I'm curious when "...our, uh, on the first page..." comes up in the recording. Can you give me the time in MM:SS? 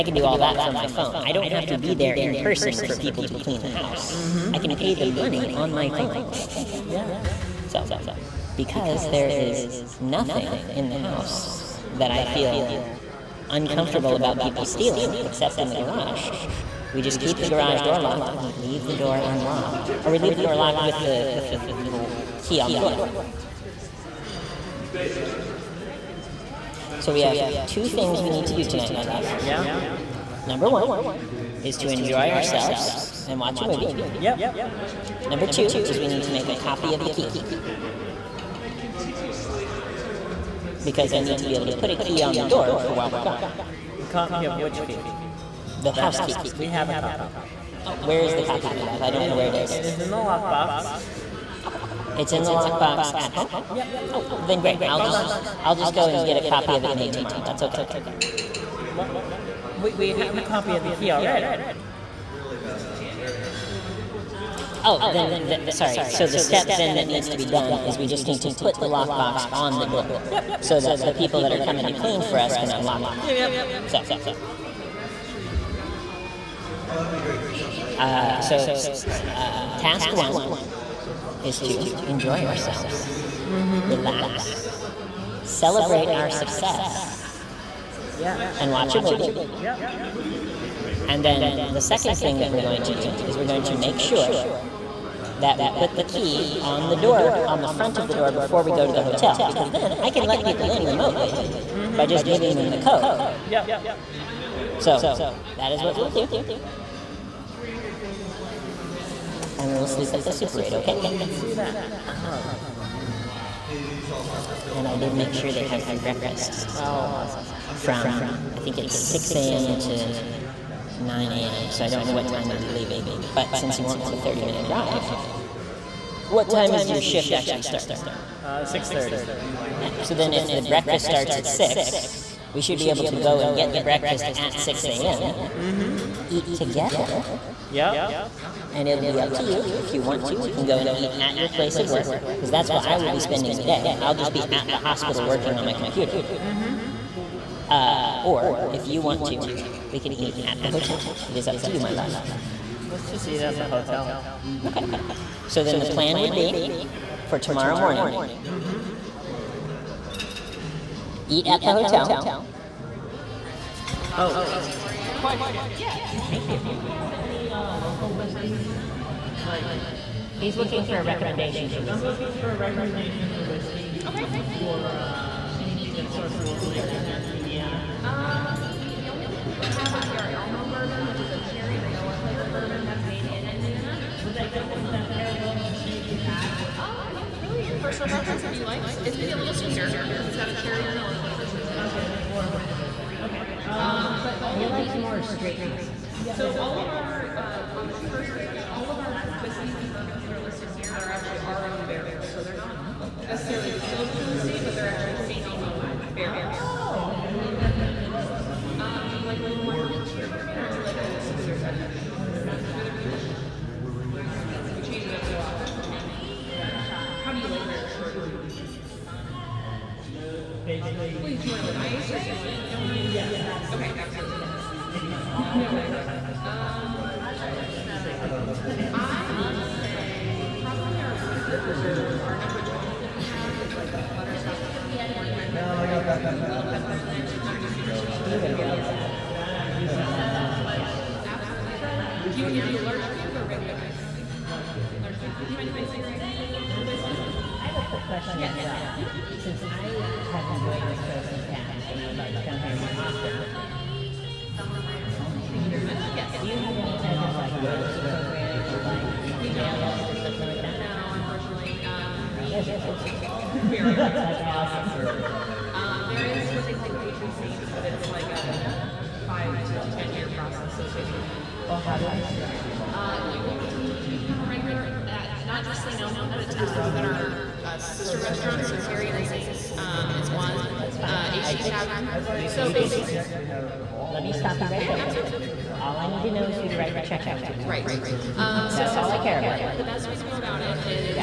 03:16.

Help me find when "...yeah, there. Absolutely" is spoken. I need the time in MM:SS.
04:44.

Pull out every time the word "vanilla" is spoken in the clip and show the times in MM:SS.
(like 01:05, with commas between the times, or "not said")
03:01, 03:10.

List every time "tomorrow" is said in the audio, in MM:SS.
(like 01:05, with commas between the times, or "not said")
00:57, 02:37.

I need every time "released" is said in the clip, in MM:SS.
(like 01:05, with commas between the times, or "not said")
not said.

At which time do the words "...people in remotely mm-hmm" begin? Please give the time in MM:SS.
01:40.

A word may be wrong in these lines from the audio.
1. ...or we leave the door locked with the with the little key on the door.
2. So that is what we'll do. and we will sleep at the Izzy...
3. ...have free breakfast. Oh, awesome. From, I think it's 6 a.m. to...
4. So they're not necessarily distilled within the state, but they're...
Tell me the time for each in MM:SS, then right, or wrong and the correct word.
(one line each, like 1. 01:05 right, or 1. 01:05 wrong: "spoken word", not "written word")
1. 00:20 right
2. 01:44 wrong: "Super", not "Izzy"
3. 01:55 right
4. 03:22 right.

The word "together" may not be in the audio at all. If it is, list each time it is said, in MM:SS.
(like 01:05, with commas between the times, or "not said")
02:16.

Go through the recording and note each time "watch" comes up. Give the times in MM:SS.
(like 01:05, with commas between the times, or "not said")
00:33, 01:28.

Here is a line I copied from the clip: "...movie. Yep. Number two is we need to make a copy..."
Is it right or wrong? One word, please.
right.